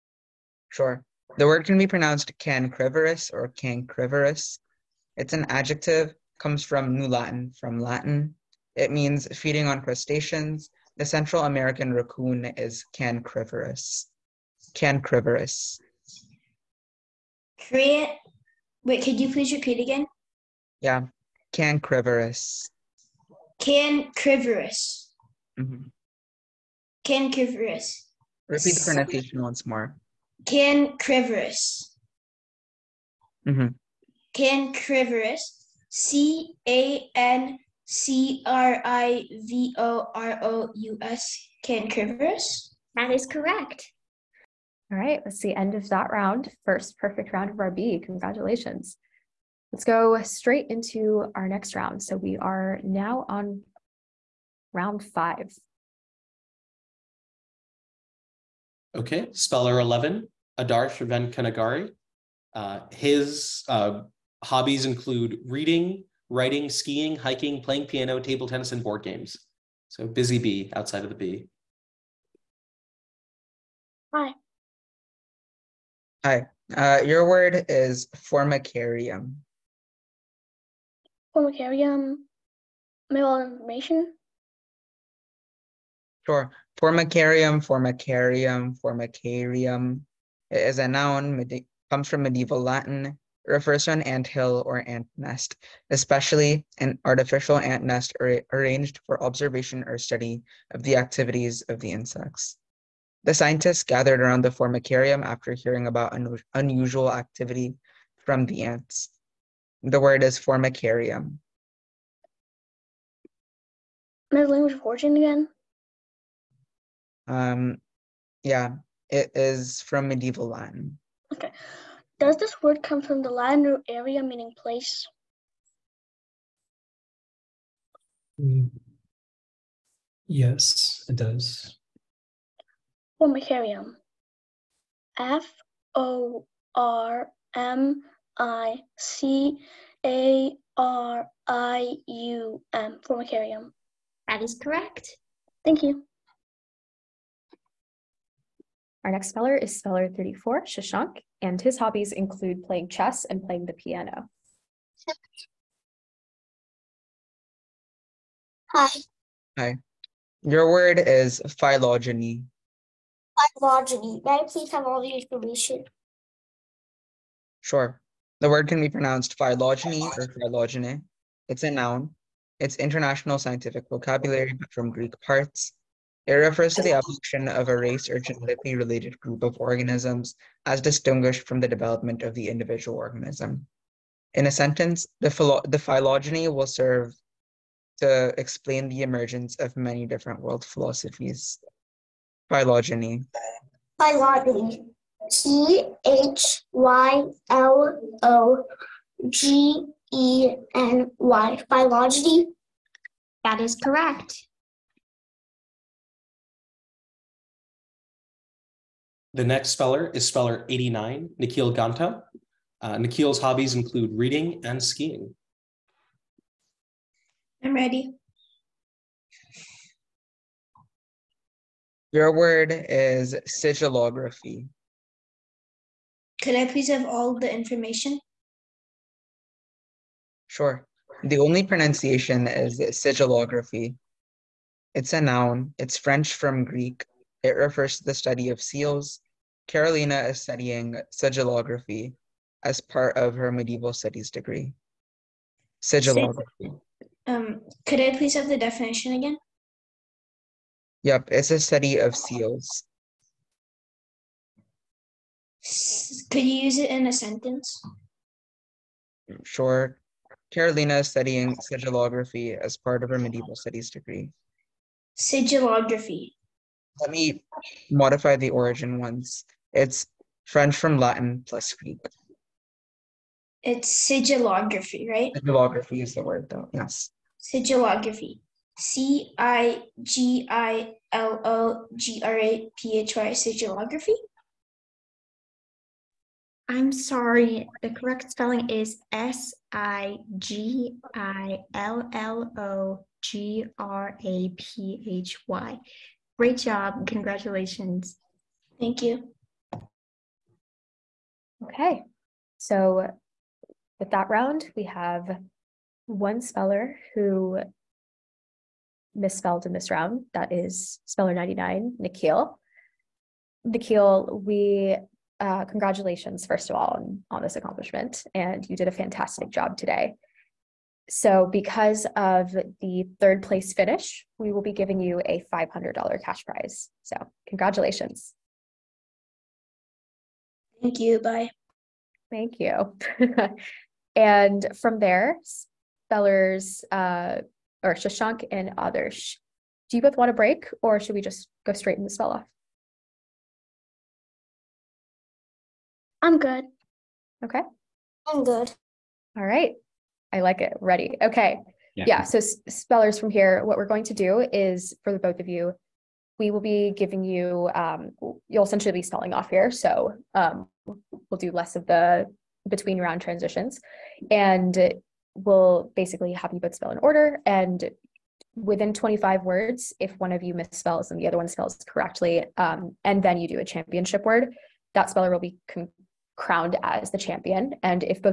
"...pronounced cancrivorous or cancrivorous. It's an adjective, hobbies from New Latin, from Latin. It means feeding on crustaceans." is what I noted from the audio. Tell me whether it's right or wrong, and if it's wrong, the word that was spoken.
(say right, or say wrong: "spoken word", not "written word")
wrong: "comes", not "hobbies".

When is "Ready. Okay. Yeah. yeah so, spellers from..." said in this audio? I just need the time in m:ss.
5:50.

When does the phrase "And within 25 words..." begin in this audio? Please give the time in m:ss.
6:07.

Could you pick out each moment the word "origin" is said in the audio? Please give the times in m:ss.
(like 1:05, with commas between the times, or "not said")
1:54, 4:28.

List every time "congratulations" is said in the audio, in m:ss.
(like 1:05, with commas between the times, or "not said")
0:48, 4:57, 5:15, 5:27.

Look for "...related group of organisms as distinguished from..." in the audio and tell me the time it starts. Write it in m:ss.
2:58.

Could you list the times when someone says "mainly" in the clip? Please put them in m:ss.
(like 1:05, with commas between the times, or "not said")
not said.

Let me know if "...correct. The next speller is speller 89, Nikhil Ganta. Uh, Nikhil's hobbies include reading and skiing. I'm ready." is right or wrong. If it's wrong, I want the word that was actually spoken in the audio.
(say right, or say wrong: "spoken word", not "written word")
right.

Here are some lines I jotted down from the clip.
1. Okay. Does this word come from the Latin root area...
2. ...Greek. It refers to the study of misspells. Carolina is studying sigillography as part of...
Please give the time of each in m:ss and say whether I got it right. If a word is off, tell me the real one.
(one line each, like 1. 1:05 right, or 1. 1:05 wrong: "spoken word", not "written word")
1. 2:01 right
2. 3:56 wrong: "seals", not "misspells".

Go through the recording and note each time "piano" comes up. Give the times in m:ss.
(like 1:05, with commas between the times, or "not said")
1:07, 2:33.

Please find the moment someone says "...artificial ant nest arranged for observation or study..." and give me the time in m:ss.
1:37.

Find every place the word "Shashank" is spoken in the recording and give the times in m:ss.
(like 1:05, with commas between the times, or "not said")
2:30, 5:37.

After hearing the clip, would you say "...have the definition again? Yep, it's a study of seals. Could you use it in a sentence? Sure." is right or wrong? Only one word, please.
right.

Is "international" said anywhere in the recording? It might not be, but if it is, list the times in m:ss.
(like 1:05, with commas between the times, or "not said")
2:52.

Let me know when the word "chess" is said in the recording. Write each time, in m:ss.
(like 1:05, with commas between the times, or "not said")
2:32.